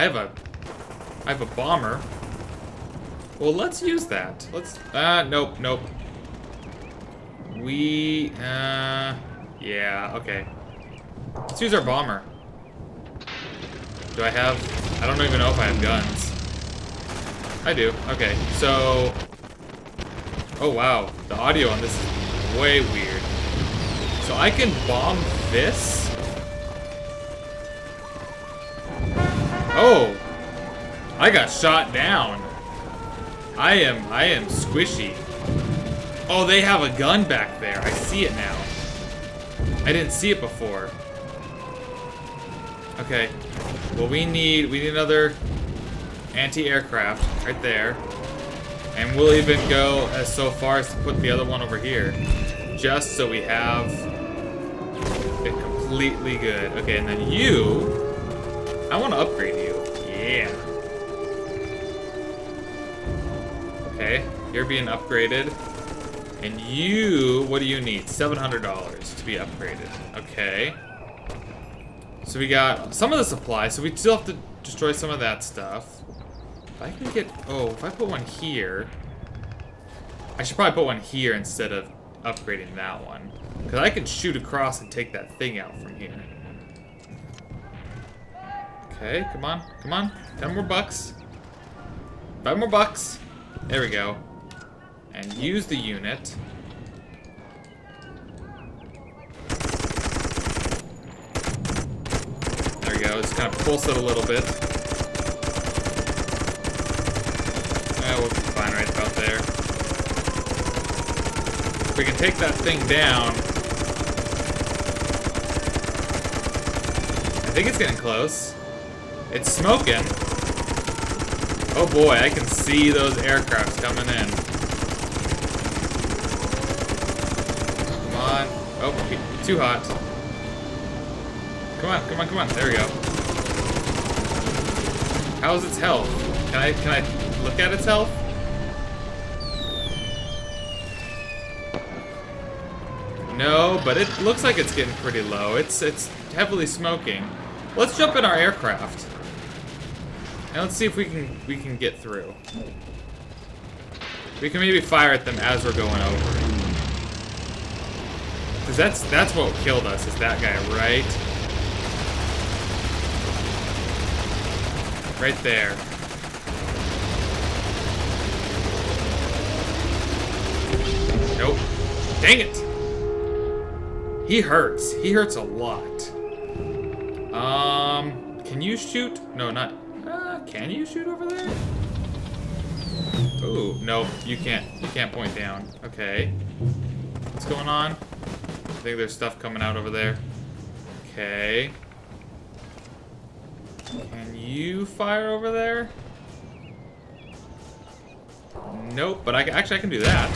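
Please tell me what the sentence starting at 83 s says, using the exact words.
Because I can shoot across and take that thing out from here.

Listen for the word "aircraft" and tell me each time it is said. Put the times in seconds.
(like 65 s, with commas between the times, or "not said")
46 s, 123 s, 148 s.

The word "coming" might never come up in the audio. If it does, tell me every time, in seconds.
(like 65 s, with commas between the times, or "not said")
123 s, 189 s.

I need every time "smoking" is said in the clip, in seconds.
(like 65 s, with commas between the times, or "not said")
119 s, 146 s.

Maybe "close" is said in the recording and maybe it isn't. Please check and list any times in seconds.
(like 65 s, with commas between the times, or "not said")
117 s.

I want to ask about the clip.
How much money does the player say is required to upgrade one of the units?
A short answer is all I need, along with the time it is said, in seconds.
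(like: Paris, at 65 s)
$700, at 68 s.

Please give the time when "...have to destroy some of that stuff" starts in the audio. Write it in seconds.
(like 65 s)
74 s.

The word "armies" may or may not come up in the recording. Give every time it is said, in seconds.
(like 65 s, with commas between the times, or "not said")
not said.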